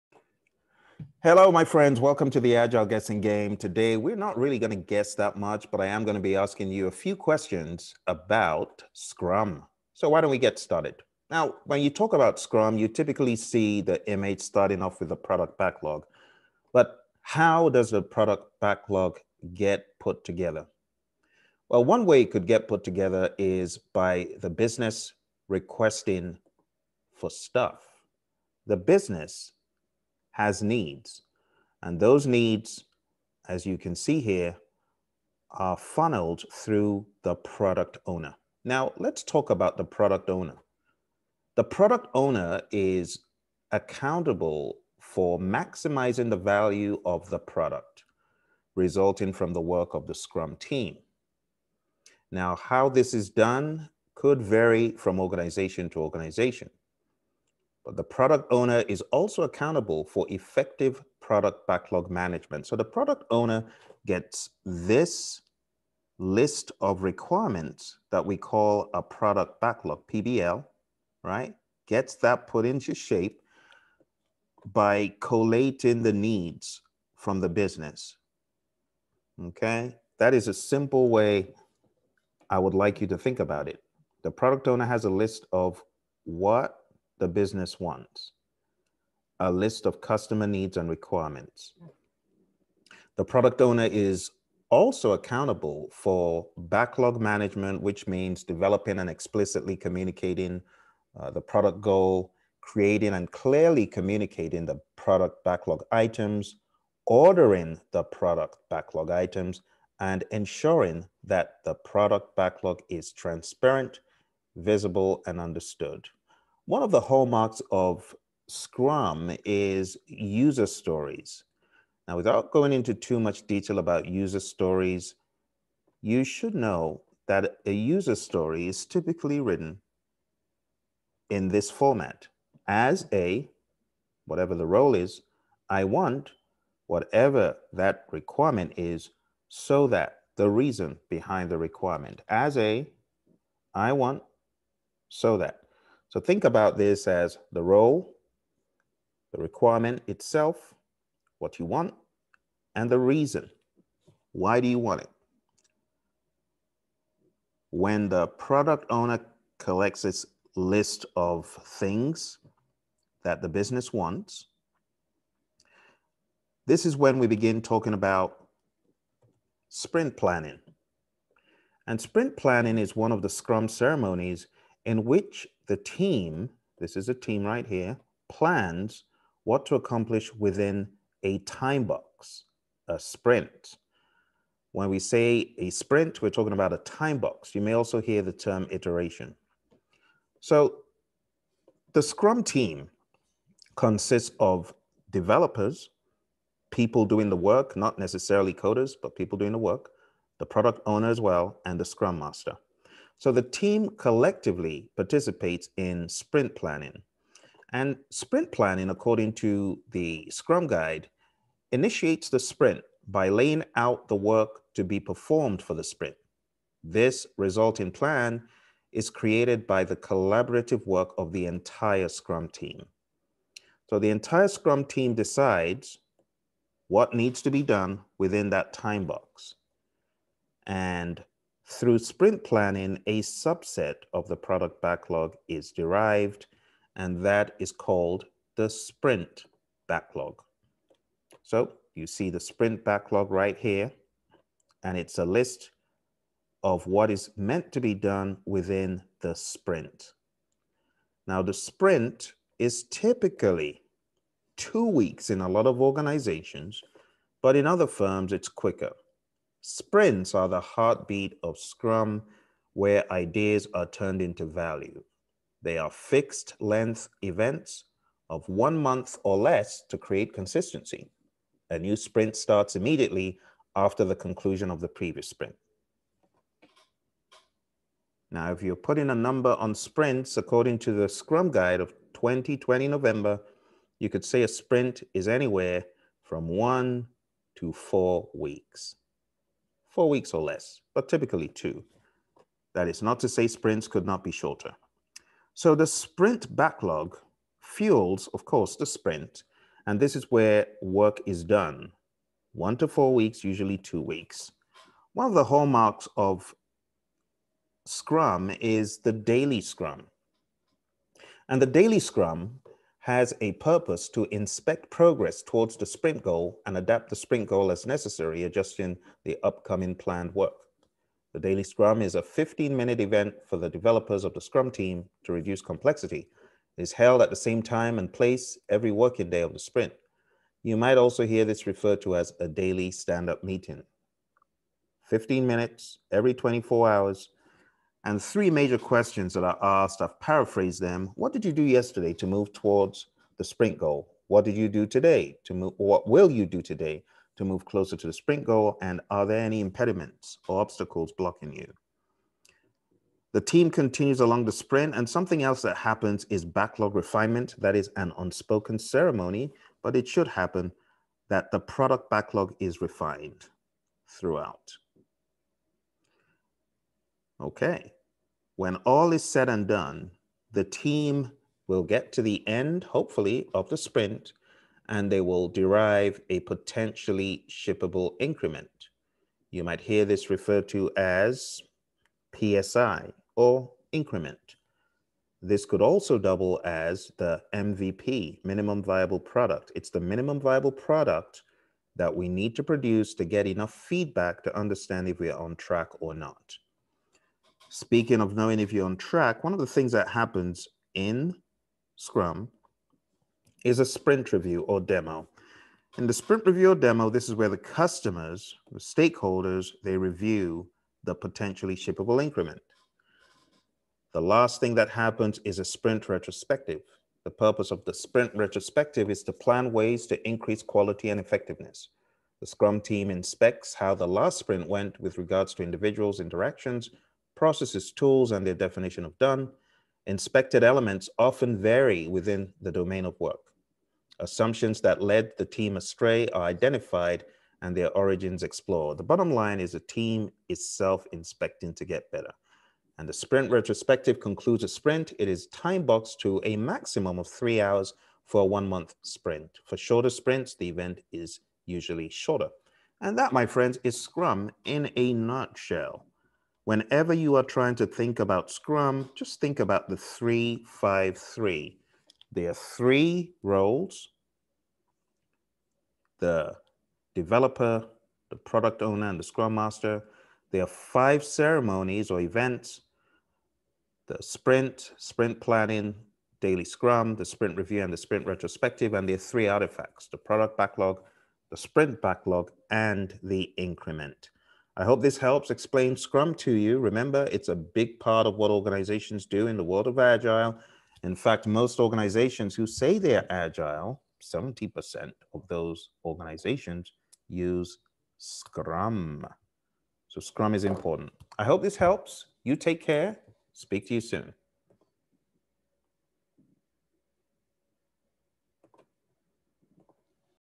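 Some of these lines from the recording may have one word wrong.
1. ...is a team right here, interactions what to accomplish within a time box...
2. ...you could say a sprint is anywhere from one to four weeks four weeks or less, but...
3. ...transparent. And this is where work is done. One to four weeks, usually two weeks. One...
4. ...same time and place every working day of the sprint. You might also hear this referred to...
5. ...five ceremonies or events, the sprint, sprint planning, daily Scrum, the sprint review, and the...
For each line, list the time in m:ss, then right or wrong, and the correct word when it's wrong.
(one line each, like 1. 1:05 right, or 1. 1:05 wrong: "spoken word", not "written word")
1. 2:56 wrong: "plans", not "interactions"
2. 4:43 right
3. 4:58 wrong: "sprint", not "transparent"
4. 5:27 right
5. 7:50 right.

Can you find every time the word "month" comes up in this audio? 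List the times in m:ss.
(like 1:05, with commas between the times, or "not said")
4:28, 7:28.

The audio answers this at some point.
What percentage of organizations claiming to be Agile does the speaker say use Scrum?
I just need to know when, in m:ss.
8:14.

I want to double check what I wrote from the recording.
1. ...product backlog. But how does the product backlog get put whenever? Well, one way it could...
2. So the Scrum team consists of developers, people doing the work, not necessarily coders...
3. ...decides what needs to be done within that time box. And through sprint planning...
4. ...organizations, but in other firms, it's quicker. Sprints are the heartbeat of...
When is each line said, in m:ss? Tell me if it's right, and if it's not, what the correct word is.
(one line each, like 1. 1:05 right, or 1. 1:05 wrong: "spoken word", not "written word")
1. 0:15 wrong: "together", not "whenever"
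2. 3:10 right
3. 3:45 right
4. 4:15 right.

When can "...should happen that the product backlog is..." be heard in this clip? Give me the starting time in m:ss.
6:00.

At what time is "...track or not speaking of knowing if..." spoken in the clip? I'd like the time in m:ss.
6:35.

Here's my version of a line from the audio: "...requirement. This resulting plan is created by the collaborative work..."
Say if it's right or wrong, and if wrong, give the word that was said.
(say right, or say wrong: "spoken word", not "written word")
wrong: "sprint", not "requirement".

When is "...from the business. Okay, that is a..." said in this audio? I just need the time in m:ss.
1:17.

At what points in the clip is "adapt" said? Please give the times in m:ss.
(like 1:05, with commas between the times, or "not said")
5:16.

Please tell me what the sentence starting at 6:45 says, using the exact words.
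In the sprint review or demo, this is where the customers, the stakeholders, they review the potentially shippable increment.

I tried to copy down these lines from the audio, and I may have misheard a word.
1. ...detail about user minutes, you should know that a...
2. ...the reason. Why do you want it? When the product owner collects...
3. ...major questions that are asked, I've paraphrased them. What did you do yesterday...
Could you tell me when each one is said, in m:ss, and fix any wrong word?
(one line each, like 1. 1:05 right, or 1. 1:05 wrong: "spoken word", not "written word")
1. 2:03 wrong: "stories", not "minutes"
2. 2:32 right
3. 5:38 right.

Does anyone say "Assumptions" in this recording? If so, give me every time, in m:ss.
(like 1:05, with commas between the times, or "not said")
7:14.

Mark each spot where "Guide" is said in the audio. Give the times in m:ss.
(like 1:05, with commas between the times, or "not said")
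3:30, 4:41.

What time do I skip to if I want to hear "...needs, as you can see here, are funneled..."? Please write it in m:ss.
0:32.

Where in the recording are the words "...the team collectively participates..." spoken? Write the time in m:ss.
3:23.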